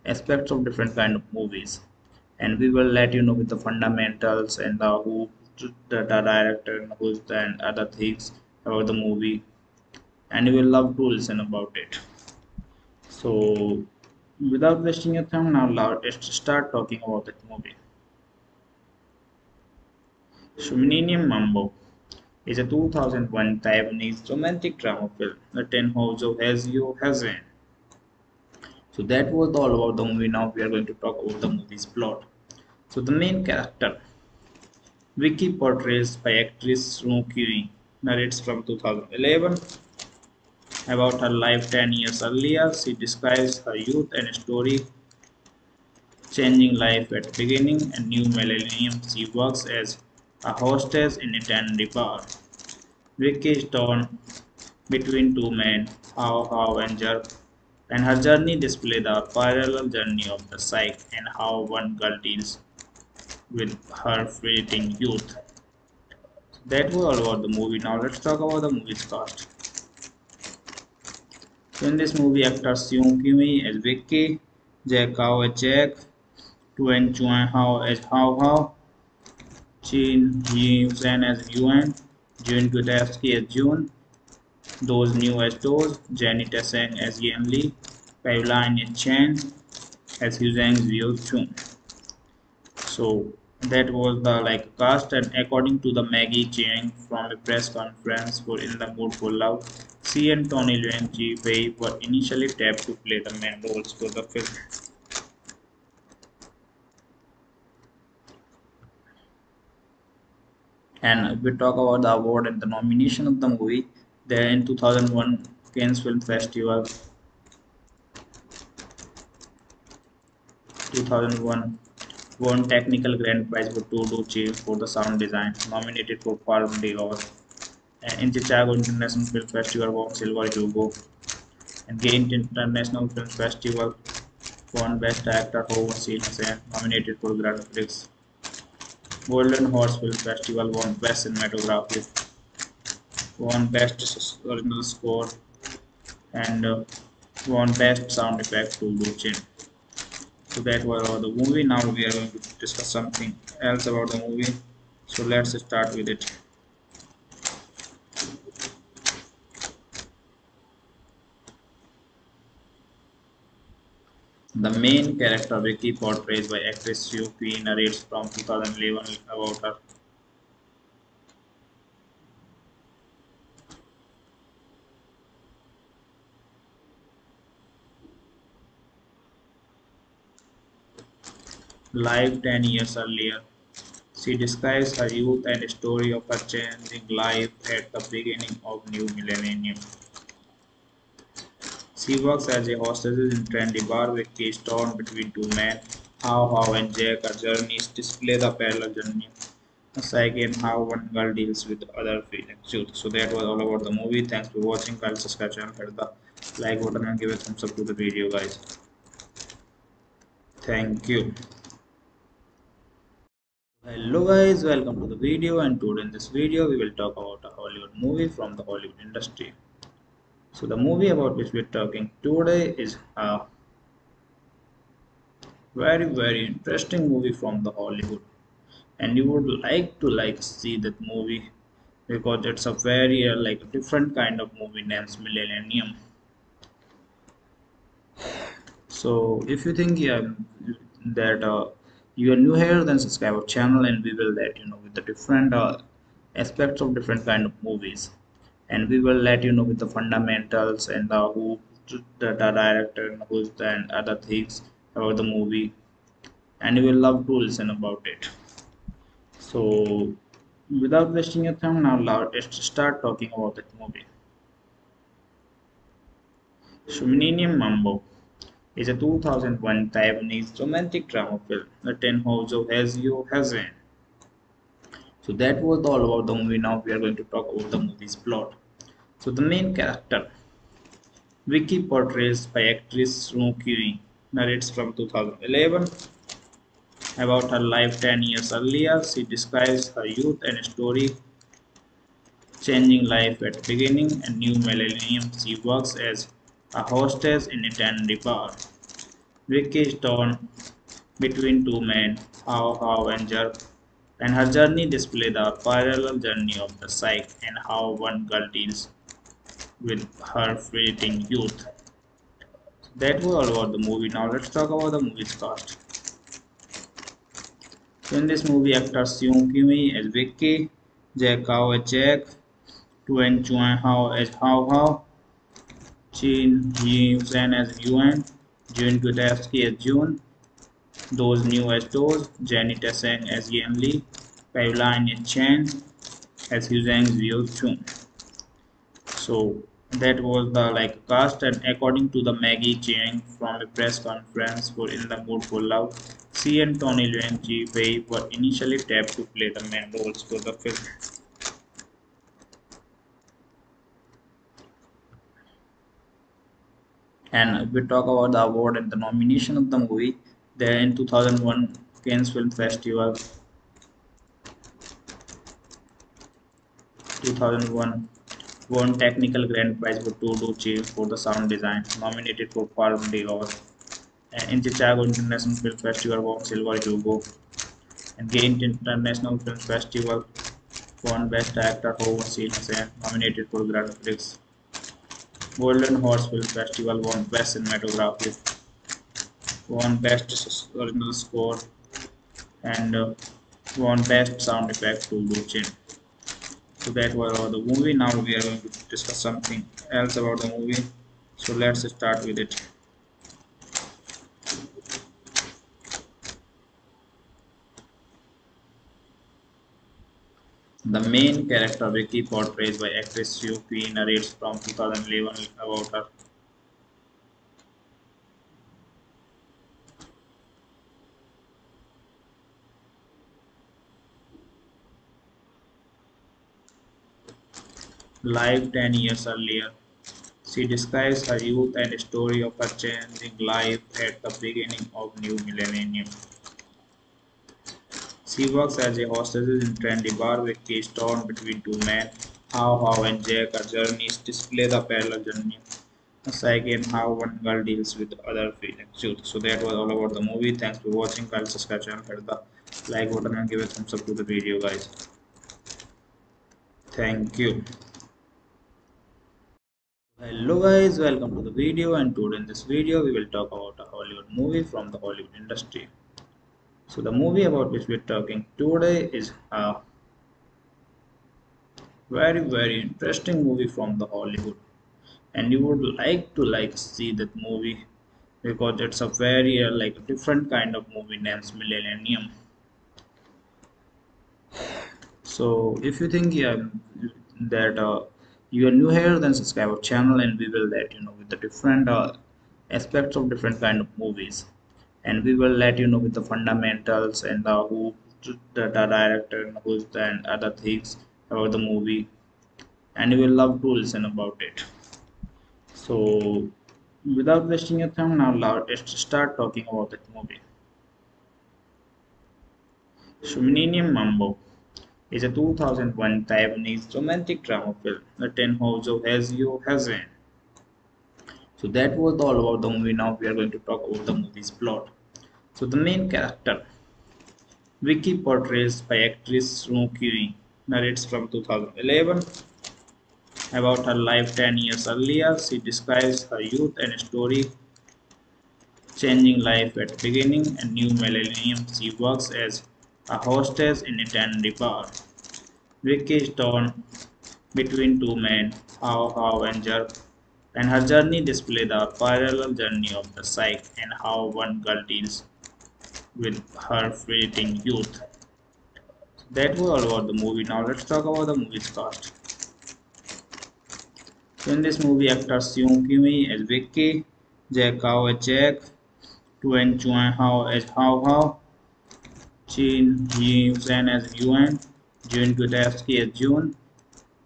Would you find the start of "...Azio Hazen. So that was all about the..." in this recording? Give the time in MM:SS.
08:39.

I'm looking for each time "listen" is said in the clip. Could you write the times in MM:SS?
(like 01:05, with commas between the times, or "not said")
00:11, 04:17, 08:23.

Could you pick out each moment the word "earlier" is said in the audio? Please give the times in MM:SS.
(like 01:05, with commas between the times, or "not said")
00:42, 03:02, 04:48, 07:09, 08:54.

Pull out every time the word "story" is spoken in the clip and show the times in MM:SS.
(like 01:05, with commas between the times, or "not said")
00:44, 03:05, 04:50, 07:12, 08:57.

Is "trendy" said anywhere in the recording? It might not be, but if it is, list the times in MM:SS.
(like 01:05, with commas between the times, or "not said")
03:13, 07:19.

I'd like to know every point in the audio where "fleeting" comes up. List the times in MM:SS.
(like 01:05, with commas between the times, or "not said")
01:04, 05:10, 09:16.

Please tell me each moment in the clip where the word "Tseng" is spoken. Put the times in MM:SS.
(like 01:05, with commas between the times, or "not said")
01:26.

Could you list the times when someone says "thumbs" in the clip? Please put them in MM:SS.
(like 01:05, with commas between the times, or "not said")
03:27, 07:33.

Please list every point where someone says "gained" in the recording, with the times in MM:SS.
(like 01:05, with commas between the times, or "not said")
06:18.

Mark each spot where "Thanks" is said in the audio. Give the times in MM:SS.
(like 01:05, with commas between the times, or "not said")
03:24, 03:30, 07:30, 07:36.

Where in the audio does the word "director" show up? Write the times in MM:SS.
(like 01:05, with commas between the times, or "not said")
00:06, 04:12, 08:18.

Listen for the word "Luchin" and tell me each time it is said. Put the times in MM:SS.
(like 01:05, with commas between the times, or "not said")
02:28, 06:35.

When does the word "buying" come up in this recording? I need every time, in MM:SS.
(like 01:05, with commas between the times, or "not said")
not said.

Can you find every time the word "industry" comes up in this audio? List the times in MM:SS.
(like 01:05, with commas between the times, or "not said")
03:39, 07:45.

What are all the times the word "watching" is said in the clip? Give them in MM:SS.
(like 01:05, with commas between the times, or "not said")
03:24, 07:31.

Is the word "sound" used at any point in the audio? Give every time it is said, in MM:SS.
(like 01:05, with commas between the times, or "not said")
02:04, 02:28, 06:11, 06:34.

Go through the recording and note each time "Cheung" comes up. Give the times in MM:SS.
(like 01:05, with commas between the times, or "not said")
01:36, 05:42.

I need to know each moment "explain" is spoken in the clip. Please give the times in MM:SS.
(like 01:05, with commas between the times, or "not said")
not said.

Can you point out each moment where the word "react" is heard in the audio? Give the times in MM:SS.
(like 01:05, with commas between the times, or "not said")
not said.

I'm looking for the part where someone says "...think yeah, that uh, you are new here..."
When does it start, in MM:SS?
03:59.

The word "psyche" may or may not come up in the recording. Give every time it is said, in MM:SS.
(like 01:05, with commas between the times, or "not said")
01:00, 03:20, 05:06, 07:26, 09:13.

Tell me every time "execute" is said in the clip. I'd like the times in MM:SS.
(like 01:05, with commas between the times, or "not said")
not said.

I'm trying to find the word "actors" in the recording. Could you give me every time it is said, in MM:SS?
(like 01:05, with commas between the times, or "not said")
01:12, 02:15, 05:18, 05:31, 06:21, 09:25.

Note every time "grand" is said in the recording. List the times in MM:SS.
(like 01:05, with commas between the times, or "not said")
02:03, 02:17, 06:09, 06:23.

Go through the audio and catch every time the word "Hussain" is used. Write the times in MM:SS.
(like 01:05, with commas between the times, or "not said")
06:22.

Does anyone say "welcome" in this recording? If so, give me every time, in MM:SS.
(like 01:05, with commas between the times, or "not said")
03:34, 07:40.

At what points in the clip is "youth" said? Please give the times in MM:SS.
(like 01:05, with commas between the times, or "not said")
00:43, 01:04, 03:05, 04:50, 05:11, 07:11, 08:56, 09:17.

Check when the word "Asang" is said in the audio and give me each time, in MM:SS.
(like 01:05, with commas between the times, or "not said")
05:32.